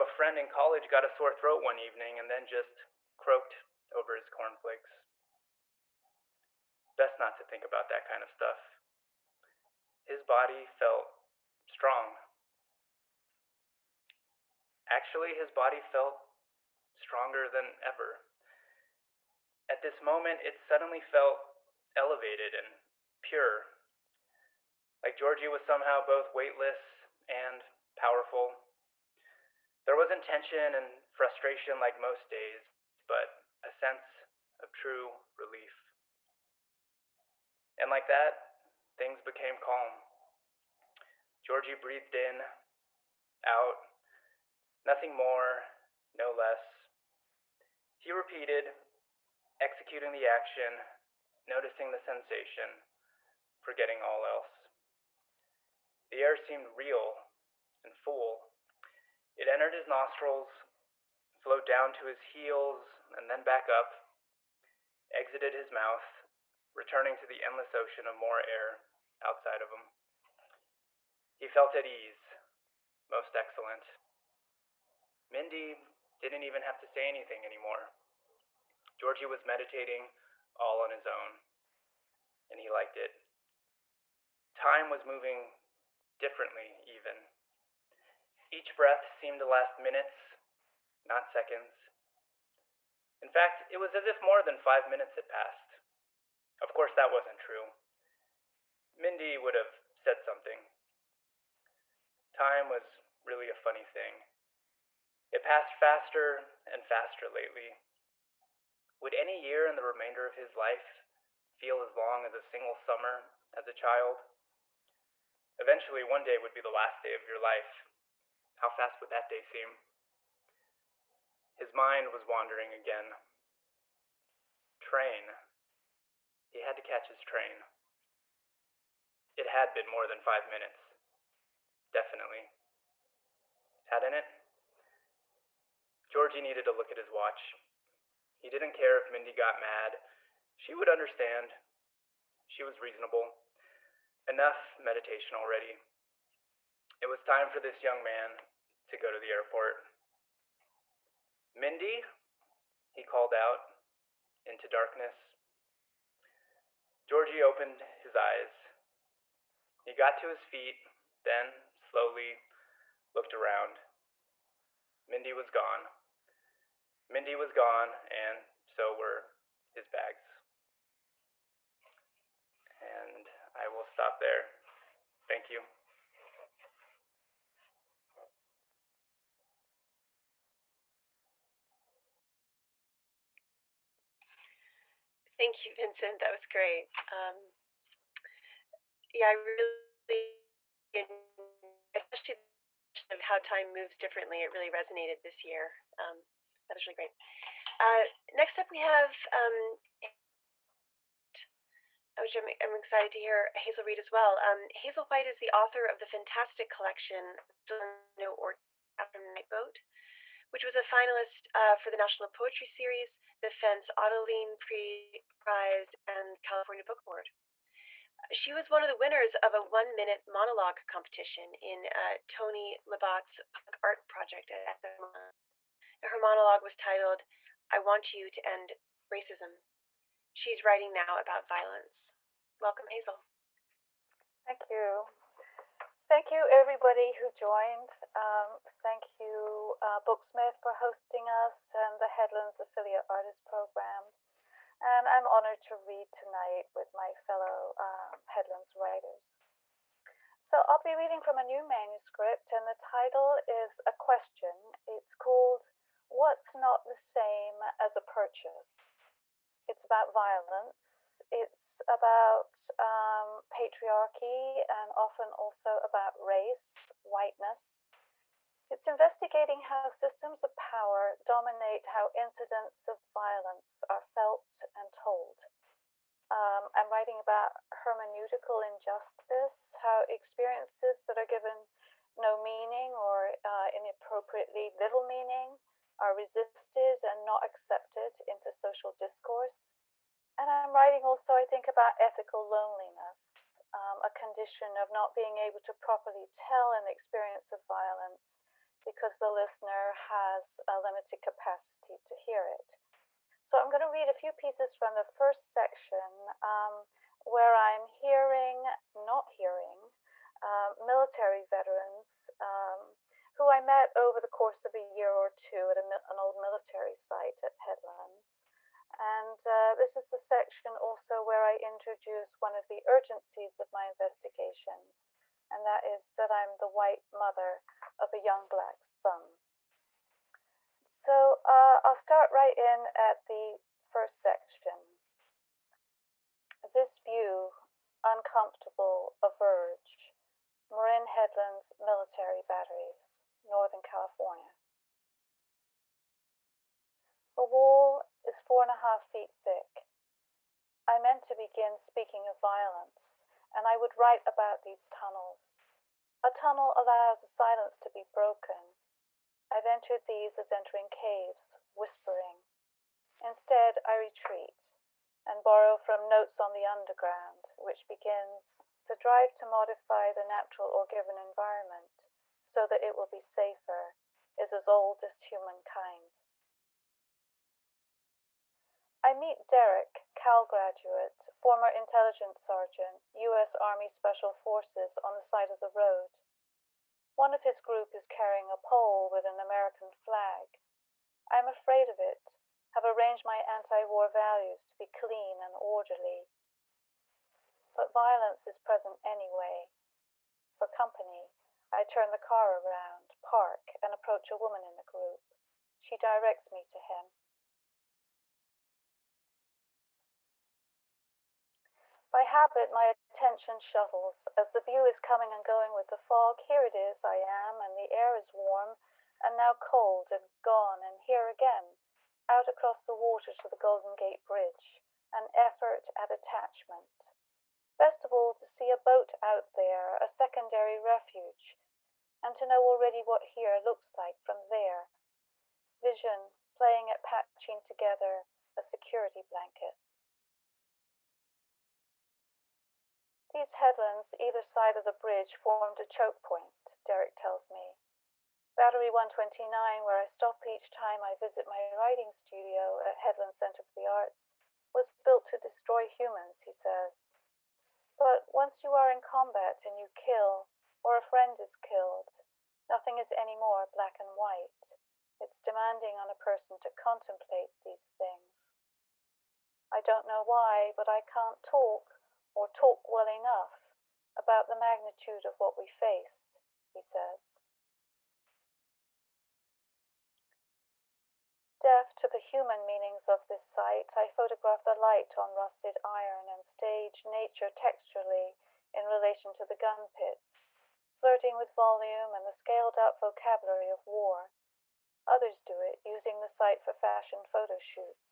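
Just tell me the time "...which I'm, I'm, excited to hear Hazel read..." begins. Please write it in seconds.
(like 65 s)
202 s.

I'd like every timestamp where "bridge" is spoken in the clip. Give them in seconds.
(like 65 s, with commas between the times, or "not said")
424 s, 444 s.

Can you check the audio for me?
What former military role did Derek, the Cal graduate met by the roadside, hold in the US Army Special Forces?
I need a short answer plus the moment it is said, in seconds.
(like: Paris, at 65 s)
Intelligence sergeant, at 381 s.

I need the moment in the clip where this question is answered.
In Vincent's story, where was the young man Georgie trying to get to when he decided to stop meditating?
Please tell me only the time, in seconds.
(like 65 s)
149 s.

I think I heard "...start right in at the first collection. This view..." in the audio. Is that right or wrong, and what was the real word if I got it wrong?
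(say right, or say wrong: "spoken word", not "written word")
wrong: "section", not "collection".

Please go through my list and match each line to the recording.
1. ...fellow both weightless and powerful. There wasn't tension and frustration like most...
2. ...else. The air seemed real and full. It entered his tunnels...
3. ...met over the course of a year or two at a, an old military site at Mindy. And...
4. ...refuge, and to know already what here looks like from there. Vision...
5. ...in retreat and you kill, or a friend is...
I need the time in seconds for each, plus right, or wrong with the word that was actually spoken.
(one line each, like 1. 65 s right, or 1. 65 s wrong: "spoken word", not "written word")
1. 25 s wrong: "somehow", not "fellow"
2. 54 s wrong: "nostrils", not "tunnels"
3. 313 s wrong: "Headlands", not "Mindy"
4. 430 s right
5. 458 s wrong: "combat", not "retreat".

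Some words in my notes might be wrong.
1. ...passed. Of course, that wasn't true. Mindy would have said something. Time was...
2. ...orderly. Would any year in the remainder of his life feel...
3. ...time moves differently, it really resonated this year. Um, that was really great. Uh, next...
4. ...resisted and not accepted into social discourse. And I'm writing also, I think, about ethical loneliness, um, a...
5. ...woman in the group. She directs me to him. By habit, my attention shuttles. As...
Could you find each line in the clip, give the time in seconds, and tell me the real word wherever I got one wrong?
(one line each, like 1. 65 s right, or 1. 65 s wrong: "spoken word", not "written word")
1. 95 s right
2. 107 s wrong: "lately", not "orderly"
3. 193 s right
4. 286 s right
5. 404 s right.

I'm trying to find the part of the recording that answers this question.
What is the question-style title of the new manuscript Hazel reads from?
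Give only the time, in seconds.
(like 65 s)
256 s.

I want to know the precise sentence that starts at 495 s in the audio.
Others do it using the site for fashion photo shoots.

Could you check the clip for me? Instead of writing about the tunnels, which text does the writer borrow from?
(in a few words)
Notes on the Underground.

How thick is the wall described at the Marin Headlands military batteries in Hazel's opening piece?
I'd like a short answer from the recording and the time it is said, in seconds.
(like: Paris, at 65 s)
4.5 feet, at 348 s.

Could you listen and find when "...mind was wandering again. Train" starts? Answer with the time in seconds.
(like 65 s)
121 s.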